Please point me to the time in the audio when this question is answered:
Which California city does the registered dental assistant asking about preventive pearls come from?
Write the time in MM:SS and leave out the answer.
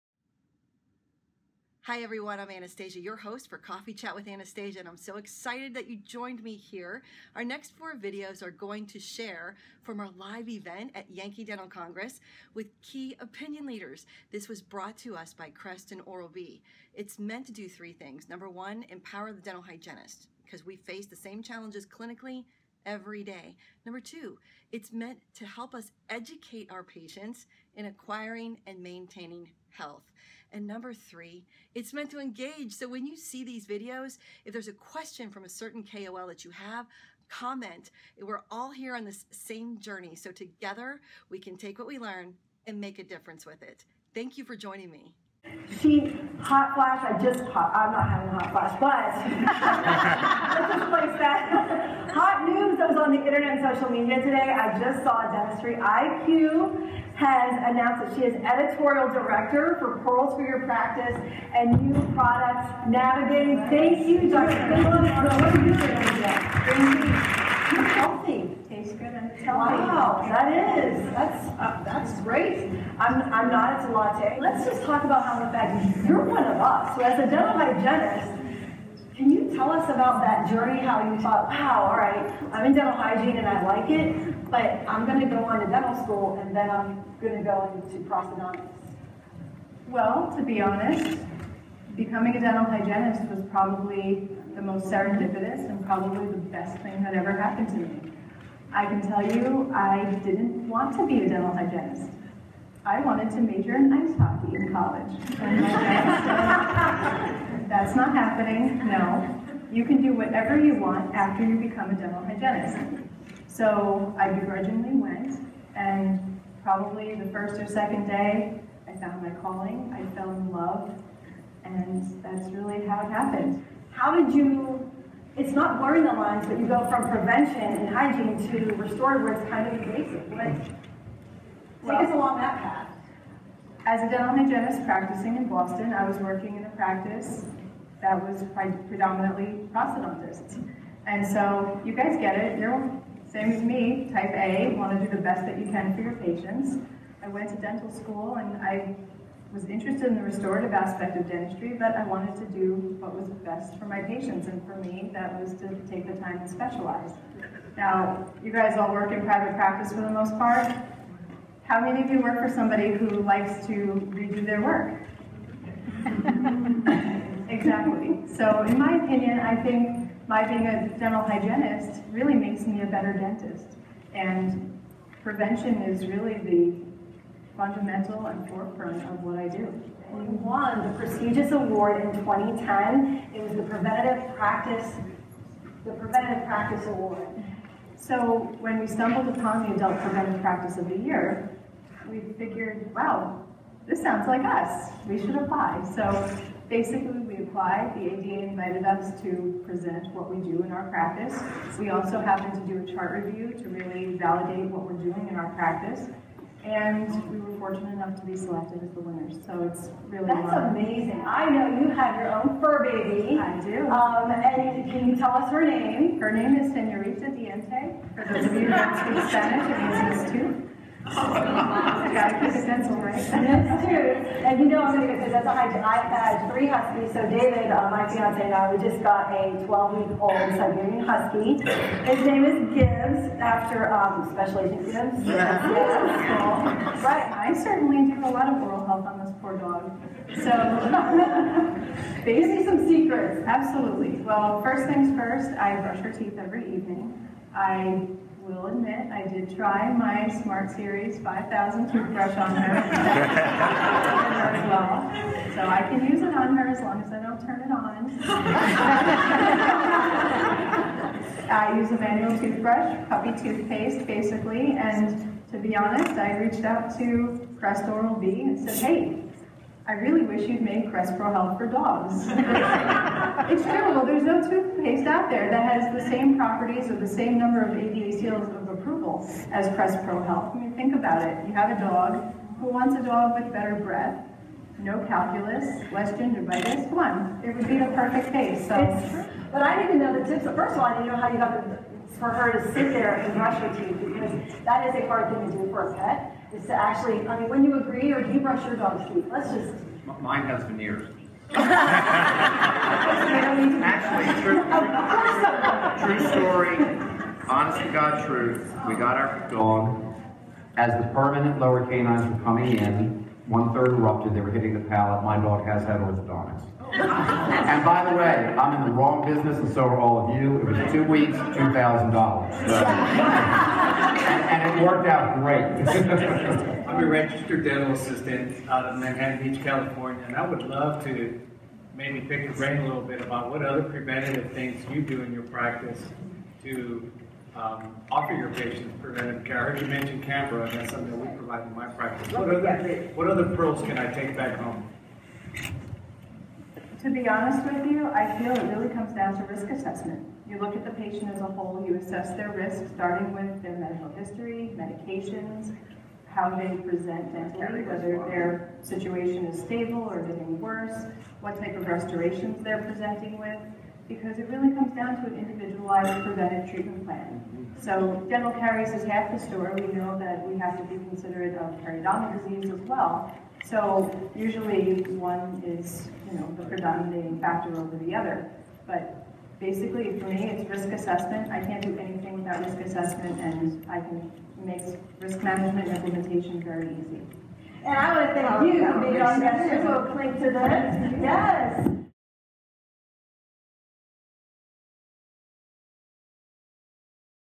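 05:28.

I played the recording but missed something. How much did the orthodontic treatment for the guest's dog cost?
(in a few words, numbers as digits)
$2,000.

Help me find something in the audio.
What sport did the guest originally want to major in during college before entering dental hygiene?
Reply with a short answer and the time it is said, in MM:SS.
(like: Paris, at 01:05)
Ice hockey, at 01:43.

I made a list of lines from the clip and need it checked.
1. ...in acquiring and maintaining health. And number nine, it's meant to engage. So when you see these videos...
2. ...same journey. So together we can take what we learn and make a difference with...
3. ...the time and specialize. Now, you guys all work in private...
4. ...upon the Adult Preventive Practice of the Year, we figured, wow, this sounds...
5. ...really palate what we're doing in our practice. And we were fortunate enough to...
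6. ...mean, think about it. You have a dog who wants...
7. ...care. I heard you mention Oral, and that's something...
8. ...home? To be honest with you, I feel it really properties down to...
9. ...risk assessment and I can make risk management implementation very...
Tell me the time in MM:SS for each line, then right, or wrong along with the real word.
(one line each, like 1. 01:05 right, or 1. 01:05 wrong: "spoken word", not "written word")
1. 00:27 wrong: "three", not "nine"
2. 00:39 right
3. 02:36 right
4. 03:09 right
5. 03:23 wrong: "validate", not "palate"
6. 04:40 right
7. 05:39 wrong: "CAMBRA", not "Oral"
8. 05:44 wrong: "comes", not "properties"
9. 06:22 right.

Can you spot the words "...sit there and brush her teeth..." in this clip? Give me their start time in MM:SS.
04:52.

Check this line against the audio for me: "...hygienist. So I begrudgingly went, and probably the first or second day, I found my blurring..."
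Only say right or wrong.
wrong.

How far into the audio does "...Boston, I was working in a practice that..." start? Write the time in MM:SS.
02:15.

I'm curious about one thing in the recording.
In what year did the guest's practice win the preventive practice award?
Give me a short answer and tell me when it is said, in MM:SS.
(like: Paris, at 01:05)
2010, at 03:02.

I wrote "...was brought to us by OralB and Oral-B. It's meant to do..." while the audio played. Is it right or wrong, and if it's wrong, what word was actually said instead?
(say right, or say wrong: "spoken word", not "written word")
wrong: "Crest", not "OralB".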